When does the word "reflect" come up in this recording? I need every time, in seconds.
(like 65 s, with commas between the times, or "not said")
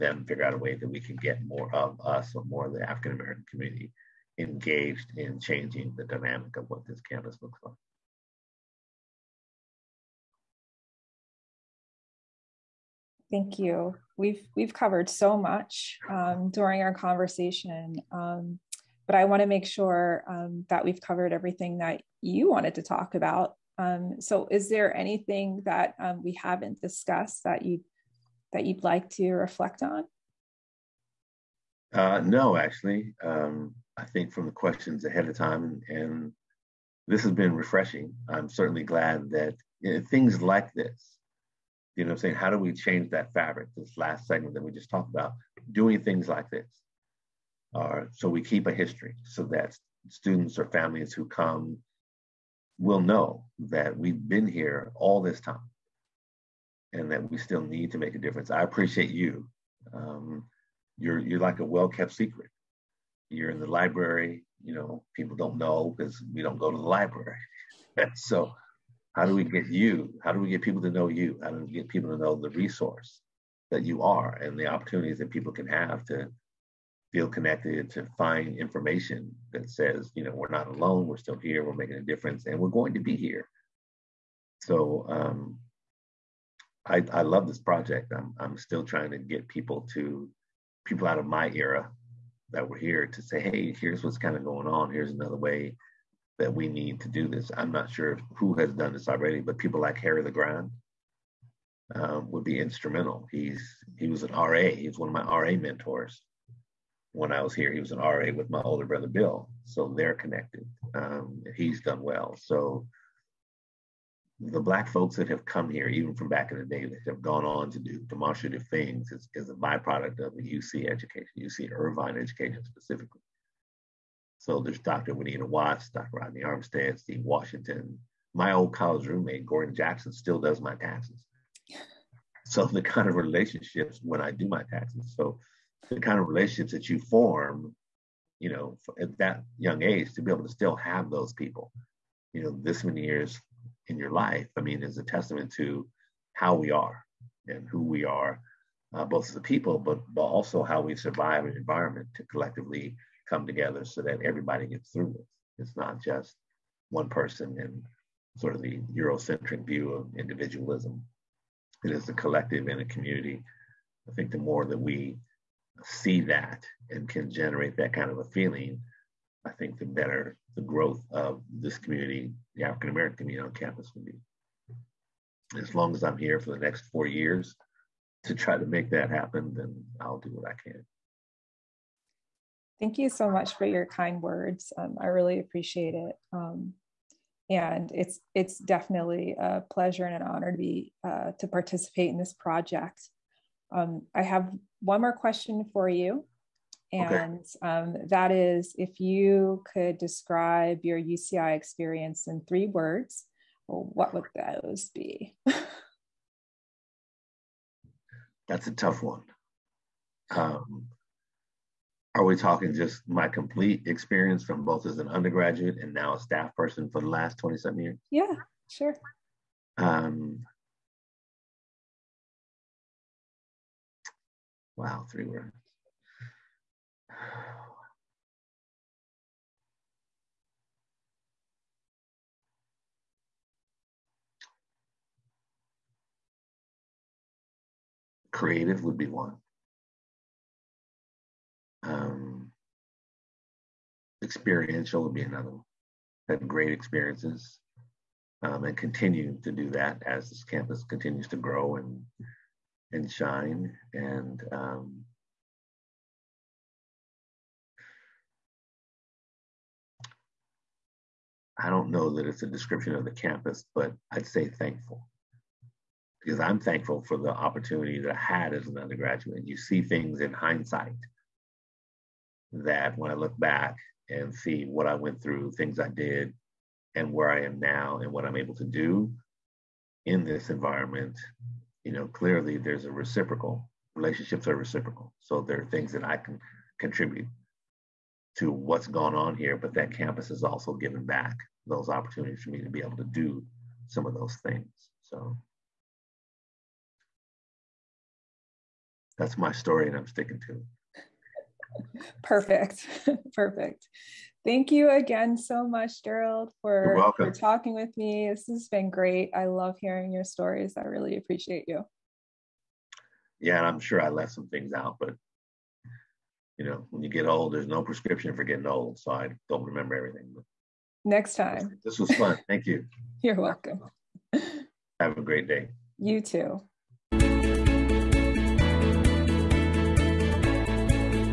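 29 s.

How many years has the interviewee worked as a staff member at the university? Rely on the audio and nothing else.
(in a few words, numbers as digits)
27.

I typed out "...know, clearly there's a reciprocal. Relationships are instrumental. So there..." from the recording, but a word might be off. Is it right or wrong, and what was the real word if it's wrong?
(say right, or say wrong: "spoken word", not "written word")
wrong: "reciprocal", not "instrumental".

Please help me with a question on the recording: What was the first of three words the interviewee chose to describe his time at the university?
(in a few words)
Creative.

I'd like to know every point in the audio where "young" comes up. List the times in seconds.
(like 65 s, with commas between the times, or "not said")
139 s.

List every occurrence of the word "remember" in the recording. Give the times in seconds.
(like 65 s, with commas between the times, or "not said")
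319 s.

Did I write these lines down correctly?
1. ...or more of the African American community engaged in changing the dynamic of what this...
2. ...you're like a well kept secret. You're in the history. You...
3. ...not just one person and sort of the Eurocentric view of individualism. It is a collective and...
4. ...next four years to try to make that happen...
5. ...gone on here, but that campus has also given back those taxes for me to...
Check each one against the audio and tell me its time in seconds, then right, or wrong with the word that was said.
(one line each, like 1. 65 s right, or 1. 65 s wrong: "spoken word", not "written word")
1. 2 s right
2. 61 s wrong: "library", not "history"
3. 155 s right
4. 176 s right
5. 288 s wrong: "opportunities", not "taxes".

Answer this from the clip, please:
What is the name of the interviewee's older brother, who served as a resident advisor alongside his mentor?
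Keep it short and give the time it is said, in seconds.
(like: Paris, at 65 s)
Bill, at 109 s.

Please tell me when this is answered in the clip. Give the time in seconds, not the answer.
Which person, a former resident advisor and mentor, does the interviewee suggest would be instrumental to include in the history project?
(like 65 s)
99 s.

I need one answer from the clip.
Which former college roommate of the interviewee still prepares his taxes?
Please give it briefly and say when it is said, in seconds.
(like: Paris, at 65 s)
Gordon Jackson, at 129 s.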